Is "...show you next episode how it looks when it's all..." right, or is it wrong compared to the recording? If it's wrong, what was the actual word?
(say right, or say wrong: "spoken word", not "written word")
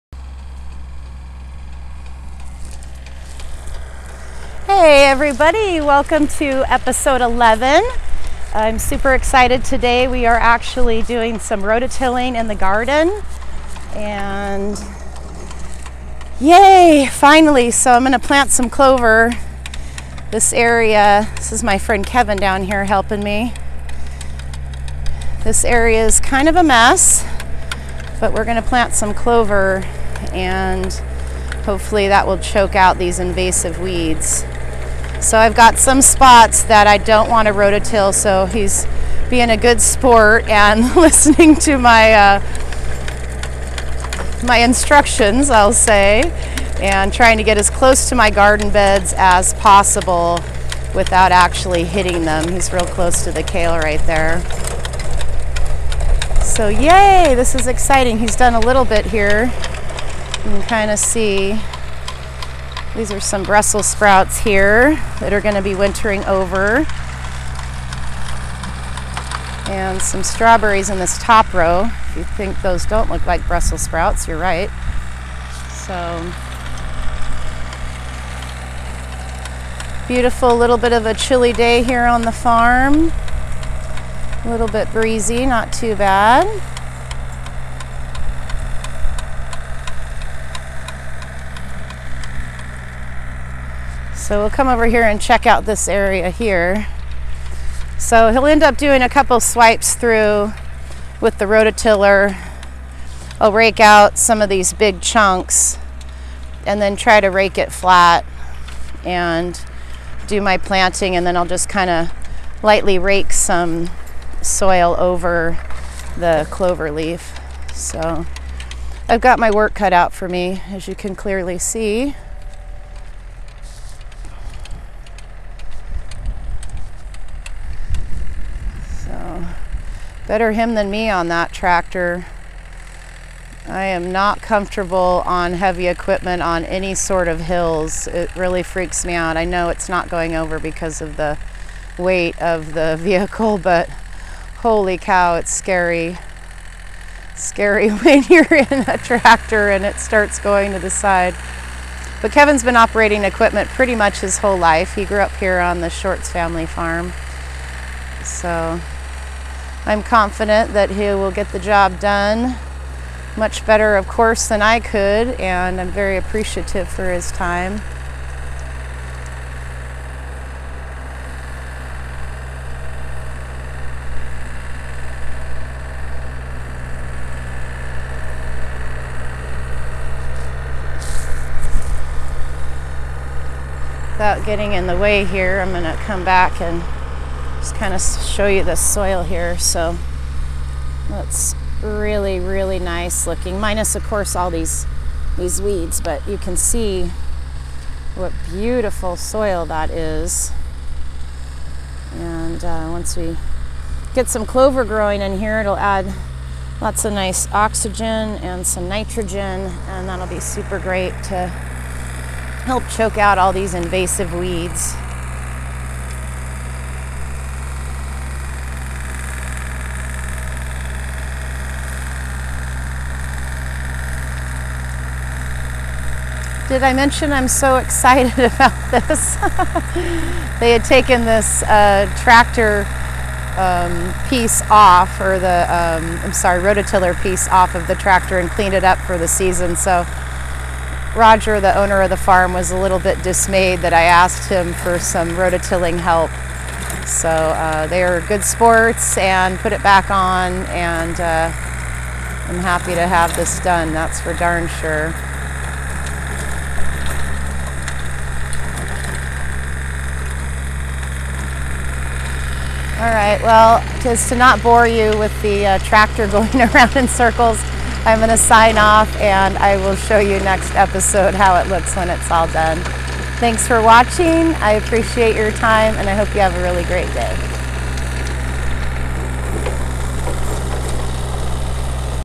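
right.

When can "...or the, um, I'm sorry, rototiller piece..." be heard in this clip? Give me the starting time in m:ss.
3:55.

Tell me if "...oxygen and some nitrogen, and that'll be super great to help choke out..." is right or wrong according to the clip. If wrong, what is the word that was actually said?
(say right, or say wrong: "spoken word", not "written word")
right.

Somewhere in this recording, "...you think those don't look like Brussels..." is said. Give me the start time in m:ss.
1:12.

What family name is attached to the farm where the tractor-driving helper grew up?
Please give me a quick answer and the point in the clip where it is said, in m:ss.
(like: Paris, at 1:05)
Shorts, at 2:35.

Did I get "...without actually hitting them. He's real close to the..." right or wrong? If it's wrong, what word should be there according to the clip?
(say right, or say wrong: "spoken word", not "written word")
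right.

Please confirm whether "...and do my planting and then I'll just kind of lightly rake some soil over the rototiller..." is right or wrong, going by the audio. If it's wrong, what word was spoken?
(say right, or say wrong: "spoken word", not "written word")
wrong: "clover", not "rototiller".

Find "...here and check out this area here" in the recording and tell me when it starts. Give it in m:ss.
1:34.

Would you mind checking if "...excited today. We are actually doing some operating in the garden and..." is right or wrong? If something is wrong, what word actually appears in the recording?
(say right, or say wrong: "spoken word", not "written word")
wrong: "rototilling", not "operating".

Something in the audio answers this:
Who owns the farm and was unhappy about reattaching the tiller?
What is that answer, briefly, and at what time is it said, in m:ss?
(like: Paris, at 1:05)
Roger, at 4:01.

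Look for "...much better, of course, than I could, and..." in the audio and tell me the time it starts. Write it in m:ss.
2:43.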